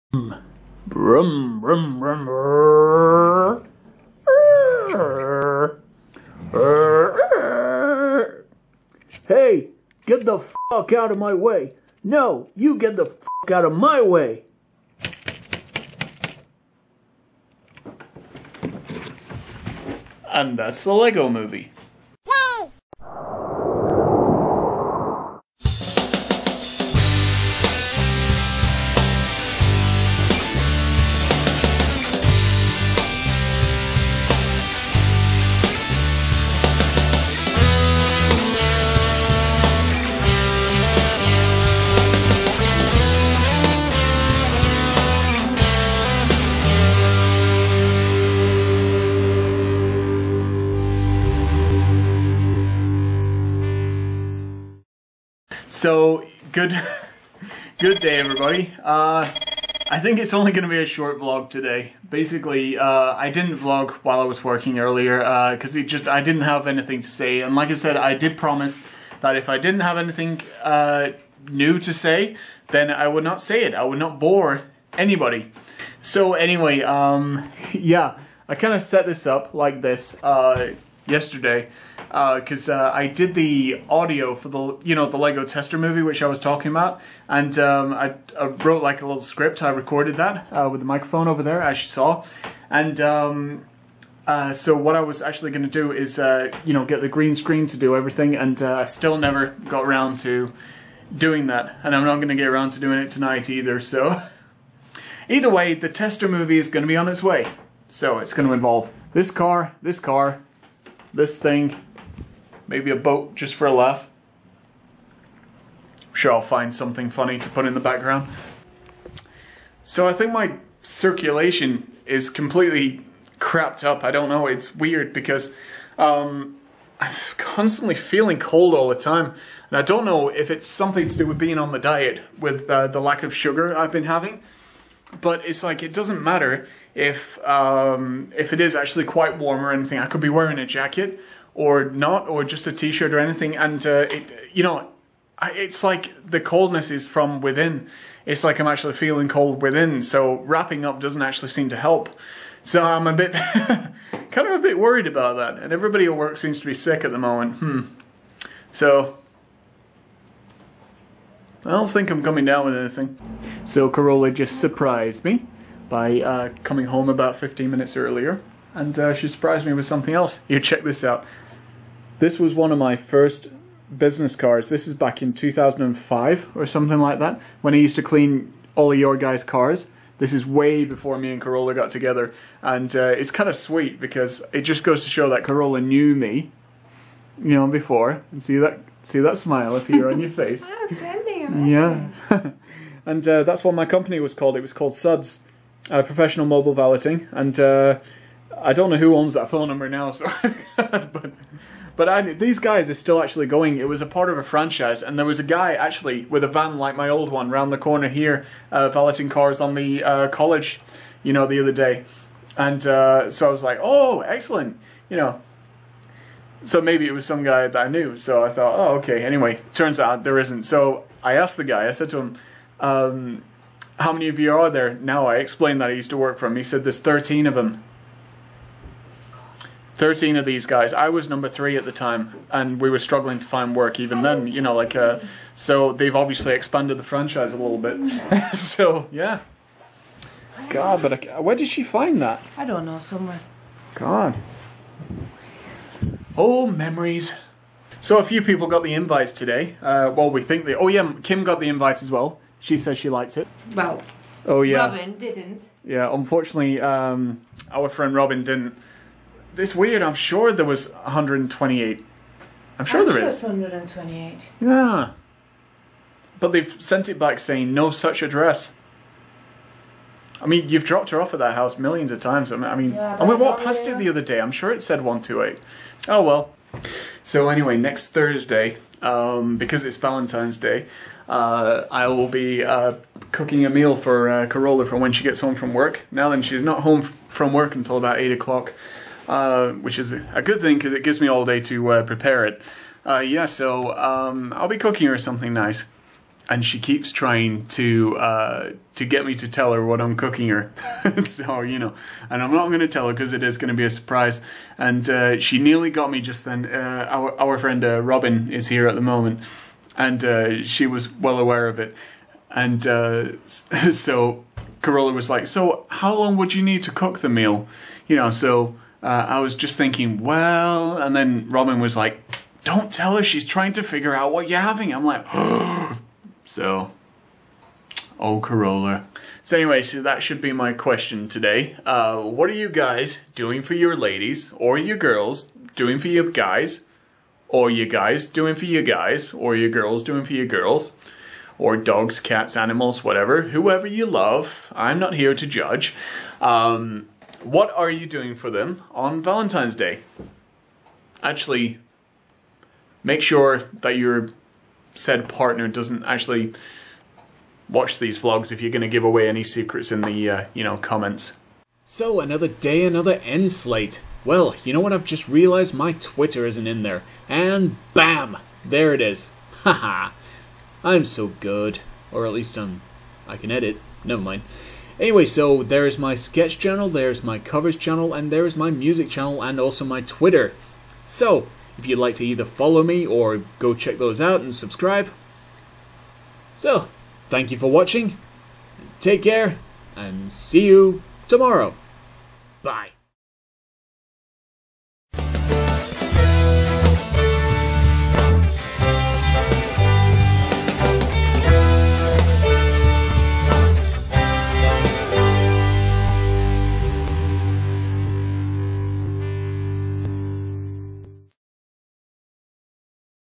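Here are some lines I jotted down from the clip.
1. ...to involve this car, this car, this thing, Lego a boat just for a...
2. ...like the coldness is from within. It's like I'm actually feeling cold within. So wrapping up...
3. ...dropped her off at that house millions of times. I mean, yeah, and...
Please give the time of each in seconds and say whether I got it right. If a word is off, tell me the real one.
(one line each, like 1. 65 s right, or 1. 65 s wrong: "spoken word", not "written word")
1. 108 s wrong: "Maybe", not "Lego"
2. 145 s right
3. 270 s right.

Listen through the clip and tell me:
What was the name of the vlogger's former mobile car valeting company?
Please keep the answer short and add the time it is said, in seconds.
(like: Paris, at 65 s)
Suds, at 194 s.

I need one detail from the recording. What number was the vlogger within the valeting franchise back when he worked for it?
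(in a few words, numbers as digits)
three.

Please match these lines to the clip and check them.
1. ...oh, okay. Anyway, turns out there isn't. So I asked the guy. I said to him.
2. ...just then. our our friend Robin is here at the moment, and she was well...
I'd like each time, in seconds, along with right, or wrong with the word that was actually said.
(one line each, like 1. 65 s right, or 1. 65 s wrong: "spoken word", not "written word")
1. 218 s right
2. 306 s right.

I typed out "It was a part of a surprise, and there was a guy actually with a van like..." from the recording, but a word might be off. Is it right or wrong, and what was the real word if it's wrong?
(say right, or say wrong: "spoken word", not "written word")
wrong: "franchise", not "surprise".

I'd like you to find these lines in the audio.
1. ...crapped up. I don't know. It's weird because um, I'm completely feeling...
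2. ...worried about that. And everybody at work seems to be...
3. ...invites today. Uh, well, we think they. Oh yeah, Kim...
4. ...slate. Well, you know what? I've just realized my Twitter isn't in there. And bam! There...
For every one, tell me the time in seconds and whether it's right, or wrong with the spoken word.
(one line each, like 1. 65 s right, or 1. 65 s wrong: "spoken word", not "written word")
1. 123 s wrong: "constantly", not "completely"
2. 154 s right
3. 248 s right
4. 363 s right.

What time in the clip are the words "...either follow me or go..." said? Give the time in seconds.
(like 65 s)
382 s.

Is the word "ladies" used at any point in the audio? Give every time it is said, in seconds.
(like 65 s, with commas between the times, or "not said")
333 s.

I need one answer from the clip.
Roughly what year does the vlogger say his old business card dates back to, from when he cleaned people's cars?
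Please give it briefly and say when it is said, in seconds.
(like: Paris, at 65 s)
2005, at 175 s.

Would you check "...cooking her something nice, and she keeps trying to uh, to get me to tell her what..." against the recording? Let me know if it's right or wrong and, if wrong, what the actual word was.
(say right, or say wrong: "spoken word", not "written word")
right.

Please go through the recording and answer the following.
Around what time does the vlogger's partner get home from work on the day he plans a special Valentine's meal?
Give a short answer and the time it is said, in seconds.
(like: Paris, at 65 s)
8 o'clock, at 288 s.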